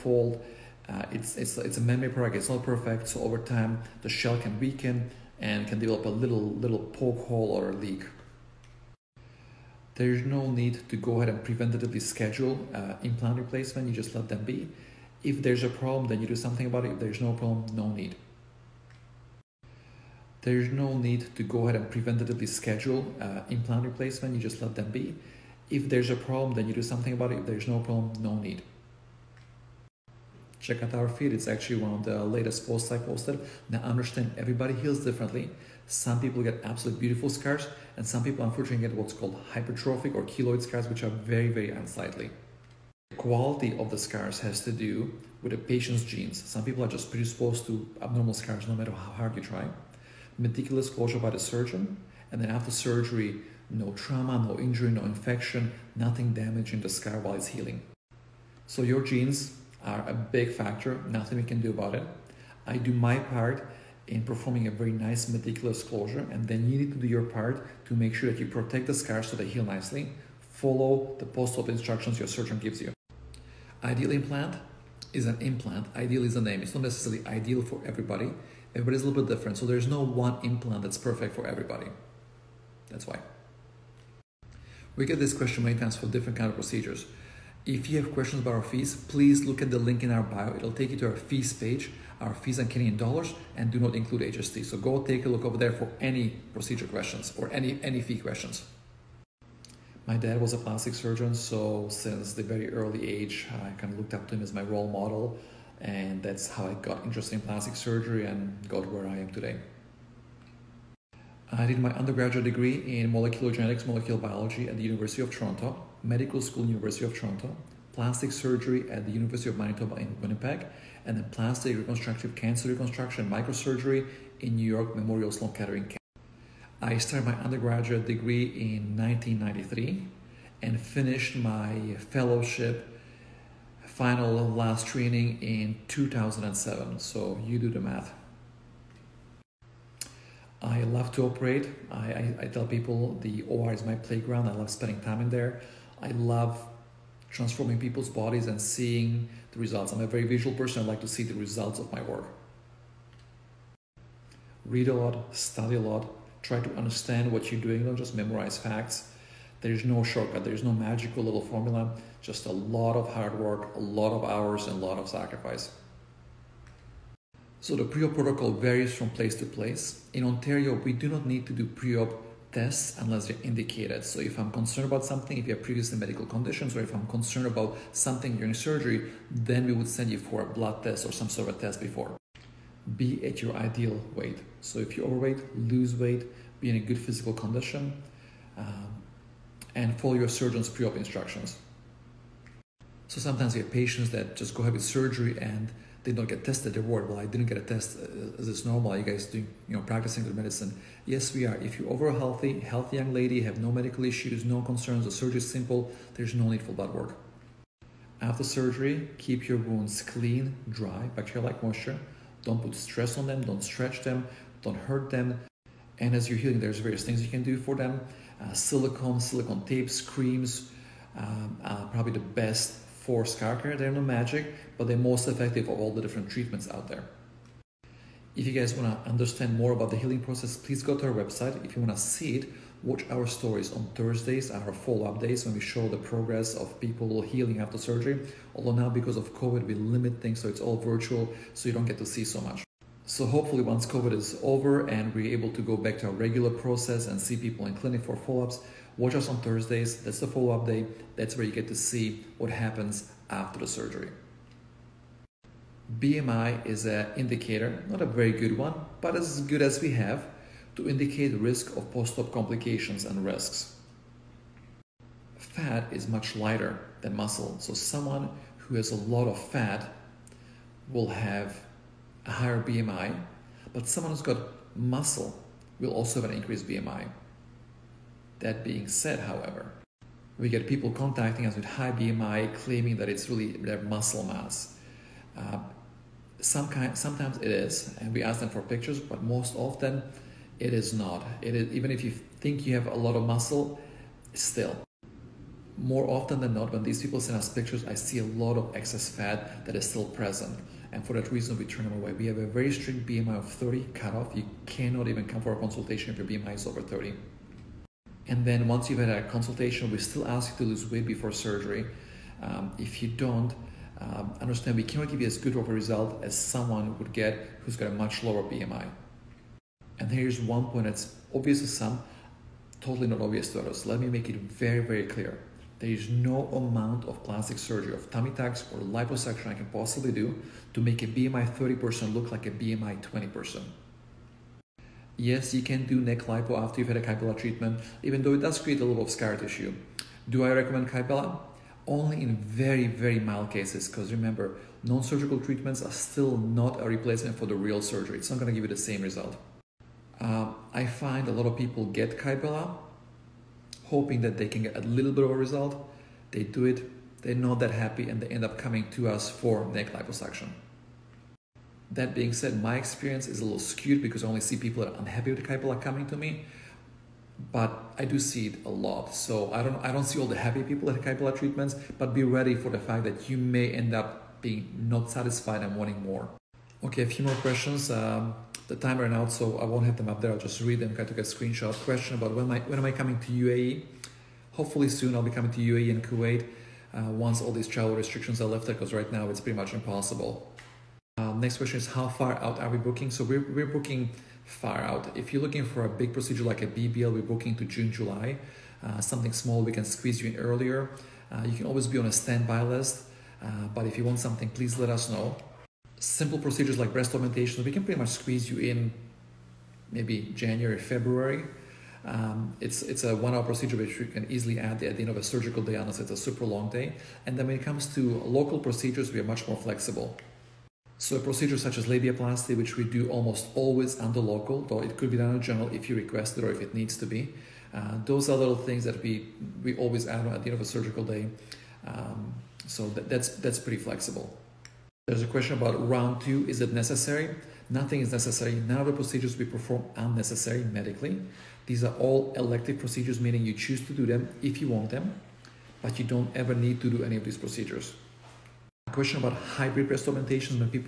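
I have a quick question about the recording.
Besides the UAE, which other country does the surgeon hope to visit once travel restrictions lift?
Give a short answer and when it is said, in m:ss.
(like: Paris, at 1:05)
Kuwait, at 6:26.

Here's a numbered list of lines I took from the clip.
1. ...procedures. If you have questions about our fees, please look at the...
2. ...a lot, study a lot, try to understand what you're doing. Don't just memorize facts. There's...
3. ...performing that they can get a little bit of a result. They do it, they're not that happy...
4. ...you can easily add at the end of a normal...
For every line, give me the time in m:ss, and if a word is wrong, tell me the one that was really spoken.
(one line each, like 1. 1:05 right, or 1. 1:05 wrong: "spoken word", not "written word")
1. 1:26 right
2. 2:34 right
3. 5:53 wrong: "hoping", not "performing"
4. 6:53 wrong: "surgical", not "normal".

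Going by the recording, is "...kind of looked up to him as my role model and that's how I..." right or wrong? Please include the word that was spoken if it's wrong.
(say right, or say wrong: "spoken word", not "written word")
right.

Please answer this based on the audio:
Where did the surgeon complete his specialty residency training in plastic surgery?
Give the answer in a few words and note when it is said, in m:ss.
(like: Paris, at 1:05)
University of Manitoba, at 1:59.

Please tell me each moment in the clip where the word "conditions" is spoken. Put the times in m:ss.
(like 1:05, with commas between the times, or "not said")
2:56, 3:07.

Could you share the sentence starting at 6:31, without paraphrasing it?
Um, next question is how far out are we booking?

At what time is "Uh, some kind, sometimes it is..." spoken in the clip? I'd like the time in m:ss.
4:45.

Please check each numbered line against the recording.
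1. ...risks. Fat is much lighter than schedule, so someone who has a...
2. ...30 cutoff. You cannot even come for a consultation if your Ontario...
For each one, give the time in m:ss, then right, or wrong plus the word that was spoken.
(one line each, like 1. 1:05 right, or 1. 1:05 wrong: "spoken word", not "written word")
1. 4:23 wrong: "muscle", not "schedule"
2. 5:03 wrong: "BMI", not "Ontario".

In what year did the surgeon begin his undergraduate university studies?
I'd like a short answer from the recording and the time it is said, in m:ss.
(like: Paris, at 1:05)
1993, at 2:08.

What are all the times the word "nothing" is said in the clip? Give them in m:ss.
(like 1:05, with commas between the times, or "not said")
0:55, 1:01, 7:17.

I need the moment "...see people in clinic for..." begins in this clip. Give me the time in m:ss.
4:07.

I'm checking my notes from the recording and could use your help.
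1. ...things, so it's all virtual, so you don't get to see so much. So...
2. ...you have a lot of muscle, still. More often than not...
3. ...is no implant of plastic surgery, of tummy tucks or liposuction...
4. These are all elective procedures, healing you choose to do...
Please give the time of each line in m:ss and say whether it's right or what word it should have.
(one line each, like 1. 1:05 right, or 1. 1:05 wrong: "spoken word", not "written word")
1. 4:00 right
2. 4:52 right
3. 5:25 wrong: "amount", not "implant"
4. 7:21 wrong: "meaning", not "healing".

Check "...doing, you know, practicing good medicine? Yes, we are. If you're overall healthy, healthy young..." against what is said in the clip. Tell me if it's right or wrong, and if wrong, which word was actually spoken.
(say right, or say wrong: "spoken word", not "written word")
right.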